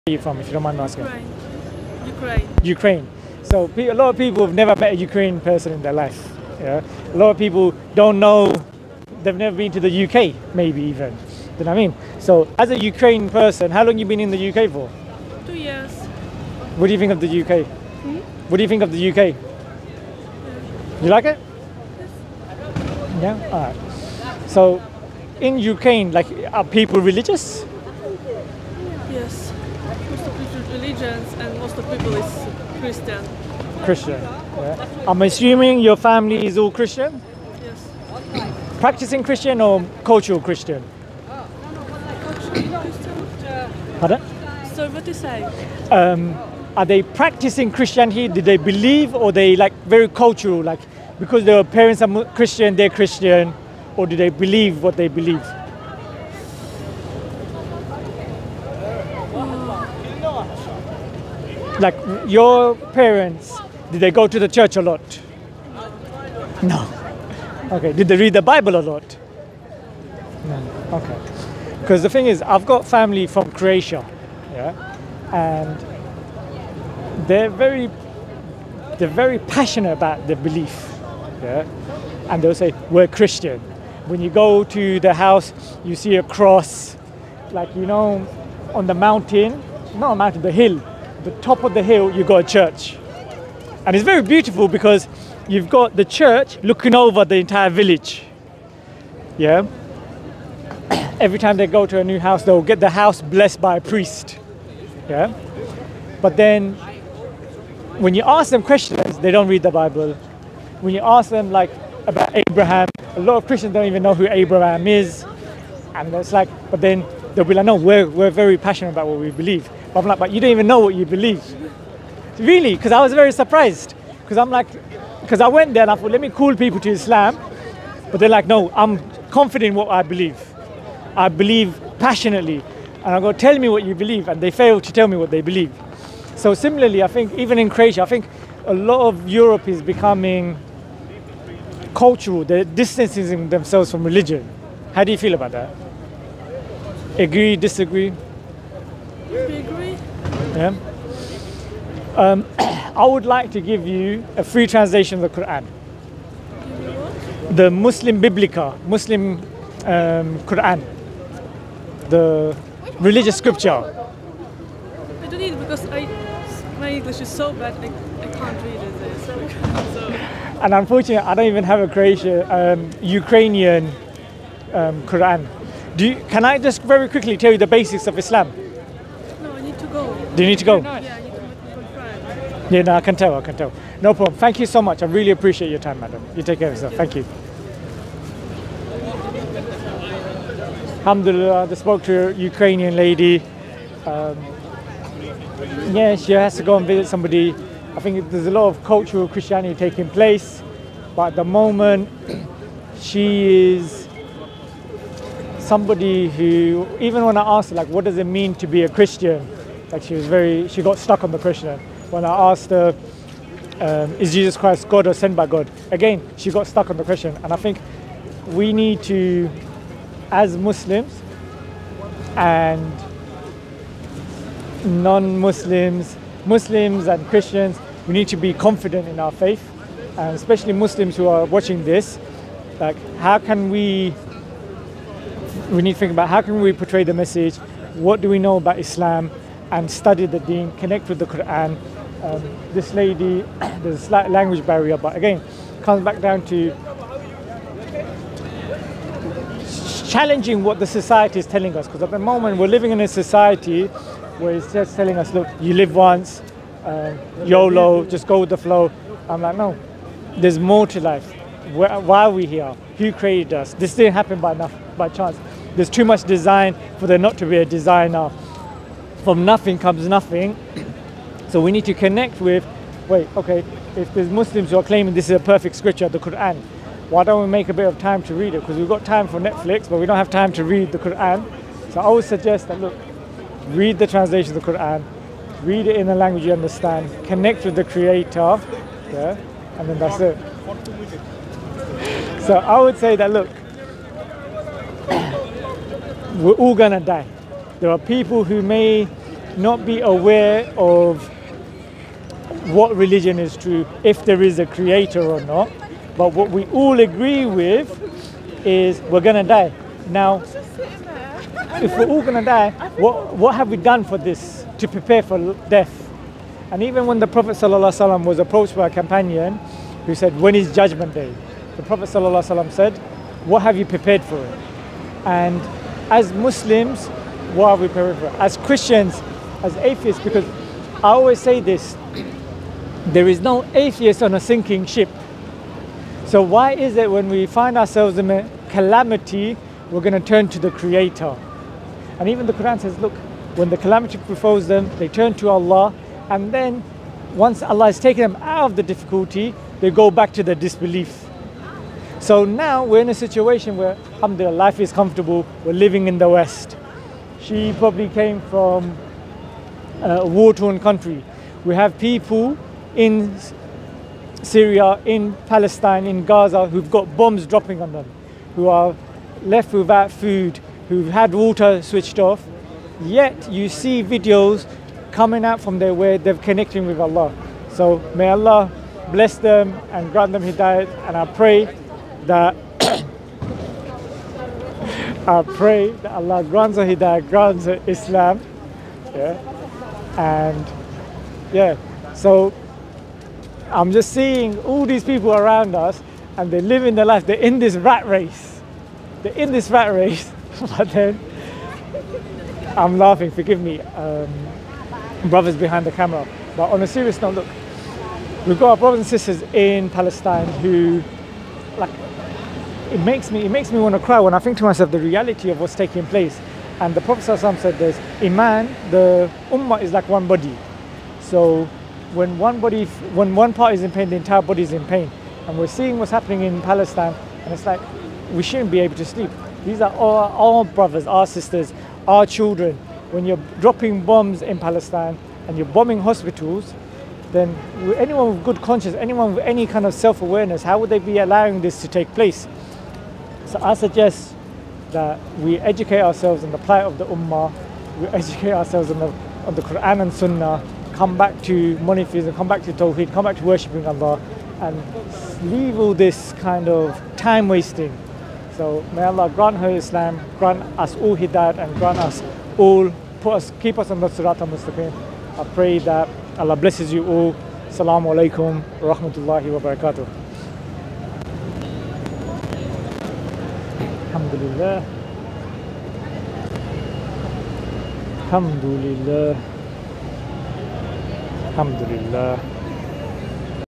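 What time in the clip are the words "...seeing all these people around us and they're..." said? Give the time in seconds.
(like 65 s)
394 s.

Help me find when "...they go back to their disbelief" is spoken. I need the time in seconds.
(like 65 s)
349 s.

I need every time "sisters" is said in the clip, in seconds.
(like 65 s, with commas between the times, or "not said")
409 s, 431 s.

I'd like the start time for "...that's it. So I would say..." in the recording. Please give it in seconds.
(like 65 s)
289 s.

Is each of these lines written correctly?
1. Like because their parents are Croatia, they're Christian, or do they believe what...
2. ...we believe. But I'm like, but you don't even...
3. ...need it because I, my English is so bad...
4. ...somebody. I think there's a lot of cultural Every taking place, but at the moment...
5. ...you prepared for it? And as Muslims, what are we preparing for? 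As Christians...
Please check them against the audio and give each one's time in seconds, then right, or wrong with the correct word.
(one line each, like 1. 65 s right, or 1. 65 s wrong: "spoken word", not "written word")
1. 50 s wrong: "Christian", not "Croatia"
2. 119 s right
3. 165 s right
4. 197 s wrong: "Christianity", not "Every"
5. 323 s right.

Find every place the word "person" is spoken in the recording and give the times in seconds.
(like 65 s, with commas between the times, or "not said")
5 s, 13 s.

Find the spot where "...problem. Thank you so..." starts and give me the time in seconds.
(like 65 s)
184 s.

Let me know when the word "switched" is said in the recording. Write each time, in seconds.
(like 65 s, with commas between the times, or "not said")
371 s.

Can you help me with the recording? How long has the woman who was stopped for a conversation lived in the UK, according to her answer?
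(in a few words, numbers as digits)
2 years.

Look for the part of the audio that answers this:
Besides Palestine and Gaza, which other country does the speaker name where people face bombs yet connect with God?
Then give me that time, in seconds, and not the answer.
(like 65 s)
364 s.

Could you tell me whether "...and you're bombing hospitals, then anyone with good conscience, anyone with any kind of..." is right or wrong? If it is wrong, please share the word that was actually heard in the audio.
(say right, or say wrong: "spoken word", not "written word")
right.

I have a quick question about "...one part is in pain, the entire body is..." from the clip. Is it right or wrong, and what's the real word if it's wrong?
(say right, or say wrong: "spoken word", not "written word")
right.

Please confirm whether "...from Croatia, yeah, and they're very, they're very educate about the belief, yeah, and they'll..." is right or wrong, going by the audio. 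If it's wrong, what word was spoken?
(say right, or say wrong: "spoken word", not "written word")
wrong: "passionate", not "educate".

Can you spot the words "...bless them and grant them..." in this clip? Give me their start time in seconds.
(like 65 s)
379 s.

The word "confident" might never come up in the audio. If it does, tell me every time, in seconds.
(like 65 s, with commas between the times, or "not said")
129 s, 228 s.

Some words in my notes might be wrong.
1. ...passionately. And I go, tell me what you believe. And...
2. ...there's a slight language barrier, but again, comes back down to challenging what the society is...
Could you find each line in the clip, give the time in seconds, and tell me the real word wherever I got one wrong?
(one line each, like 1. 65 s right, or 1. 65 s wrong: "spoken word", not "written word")
1. 131 s right
2. 243 s right.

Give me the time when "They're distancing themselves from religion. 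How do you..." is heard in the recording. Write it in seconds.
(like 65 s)
142 s.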